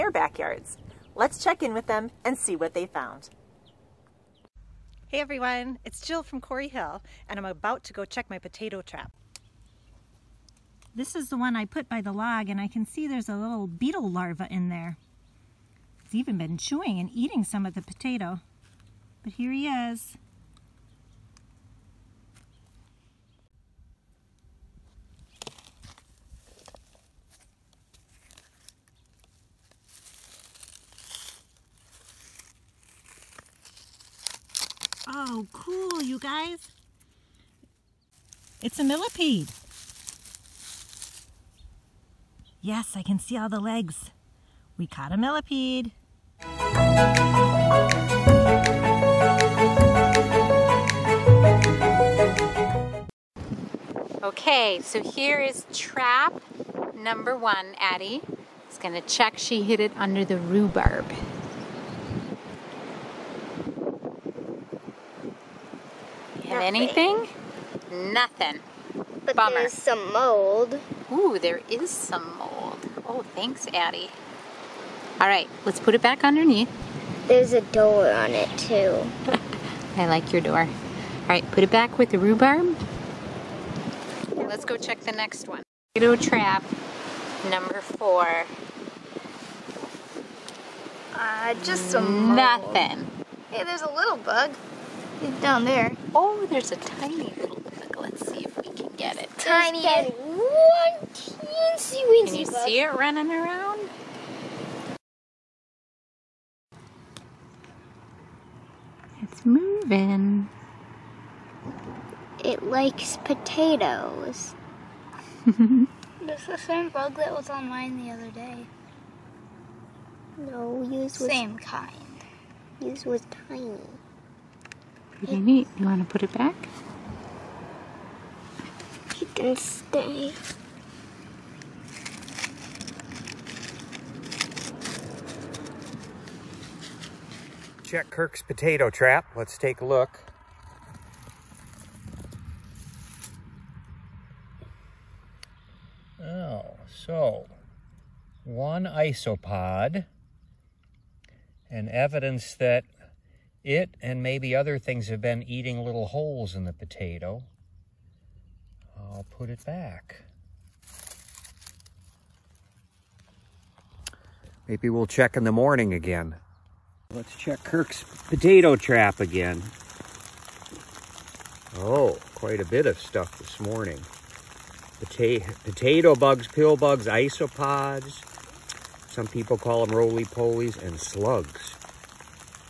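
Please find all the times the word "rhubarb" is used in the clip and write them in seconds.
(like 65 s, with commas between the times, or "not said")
60 s, 82 s.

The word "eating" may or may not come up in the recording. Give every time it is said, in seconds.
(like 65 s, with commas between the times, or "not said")
17 s, 155 s.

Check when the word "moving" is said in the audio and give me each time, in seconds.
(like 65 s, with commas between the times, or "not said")
109 s.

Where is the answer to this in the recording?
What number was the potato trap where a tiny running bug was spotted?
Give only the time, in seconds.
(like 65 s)
87 s.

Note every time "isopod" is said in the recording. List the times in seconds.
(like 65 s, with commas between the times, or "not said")
148 s, 177 s.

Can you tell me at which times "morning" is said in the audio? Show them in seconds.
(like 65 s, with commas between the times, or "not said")
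165 s, 173 s.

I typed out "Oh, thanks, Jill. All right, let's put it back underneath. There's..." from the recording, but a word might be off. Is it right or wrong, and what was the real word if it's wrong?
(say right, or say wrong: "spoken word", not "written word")
wrong: "Addie", not "Jill".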